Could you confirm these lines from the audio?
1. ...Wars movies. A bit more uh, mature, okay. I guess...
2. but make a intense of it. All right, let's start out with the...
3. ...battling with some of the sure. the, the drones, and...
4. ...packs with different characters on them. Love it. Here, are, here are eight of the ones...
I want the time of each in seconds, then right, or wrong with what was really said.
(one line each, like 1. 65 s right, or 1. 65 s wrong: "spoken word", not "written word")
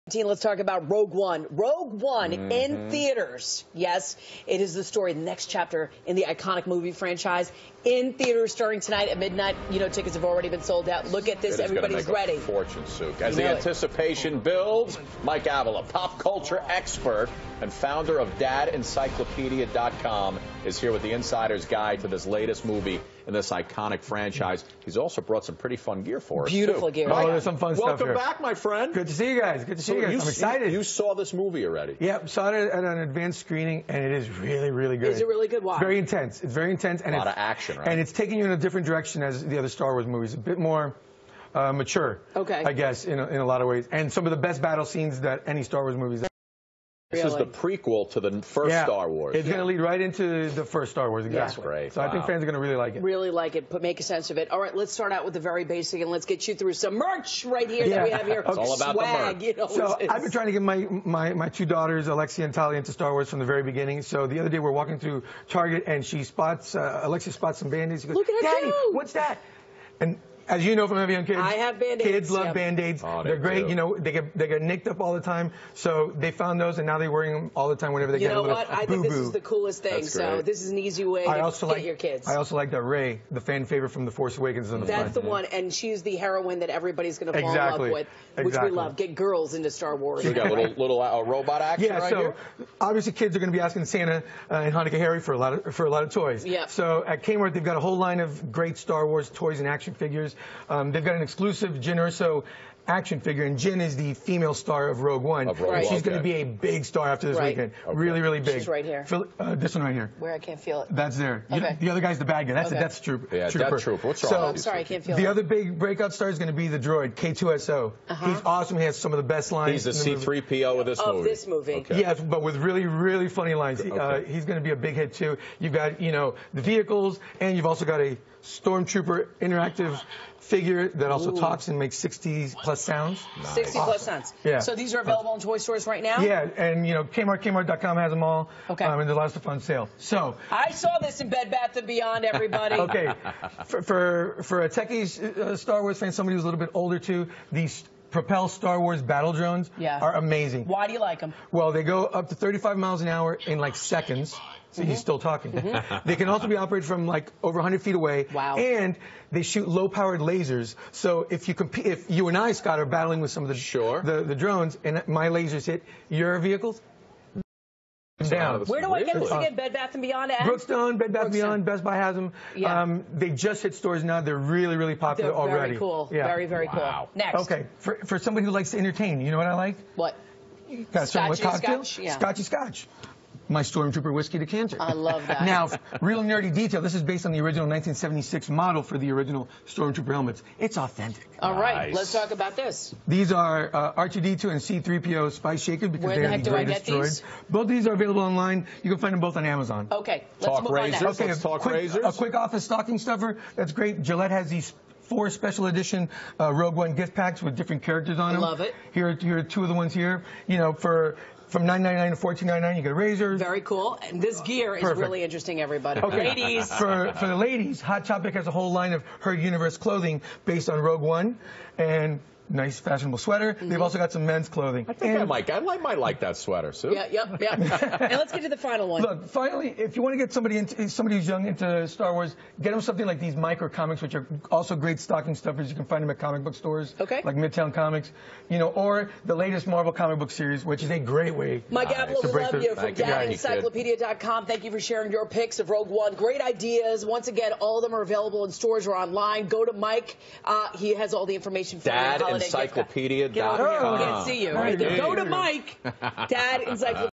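1. 39 s right
2. 53 s wrong: "sense", not "intense"
3. 162 s right
4. 207 s wrong: "two", not "eight".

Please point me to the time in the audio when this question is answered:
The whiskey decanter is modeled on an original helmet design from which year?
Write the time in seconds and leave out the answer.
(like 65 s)
187 s.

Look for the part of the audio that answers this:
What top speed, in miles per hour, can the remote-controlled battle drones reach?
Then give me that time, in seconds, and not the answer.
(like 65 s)
152 s.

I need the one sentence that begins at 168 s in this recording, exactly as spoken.
Where do I get this again?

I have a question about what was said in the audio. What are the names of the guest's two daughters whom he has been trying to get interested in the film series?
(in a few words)
Alexia and Talia.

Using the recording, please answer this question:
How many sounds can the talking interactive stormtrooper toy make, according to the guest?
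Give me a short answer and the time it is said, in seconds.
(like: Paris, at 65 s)
60 plus, at 131 s.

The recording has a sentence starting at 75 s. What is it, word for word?
So they found those, and now they're wearing them all the time whenever they you get a little You know what?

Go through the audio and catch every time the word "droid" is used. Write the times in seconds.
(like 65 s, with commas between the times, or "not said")
116 s, 196 s.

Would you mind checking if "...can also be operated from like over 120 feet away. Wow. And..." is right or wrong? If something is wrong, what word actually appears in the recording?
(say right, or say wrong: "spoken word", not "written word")
wrong: "100", not "120".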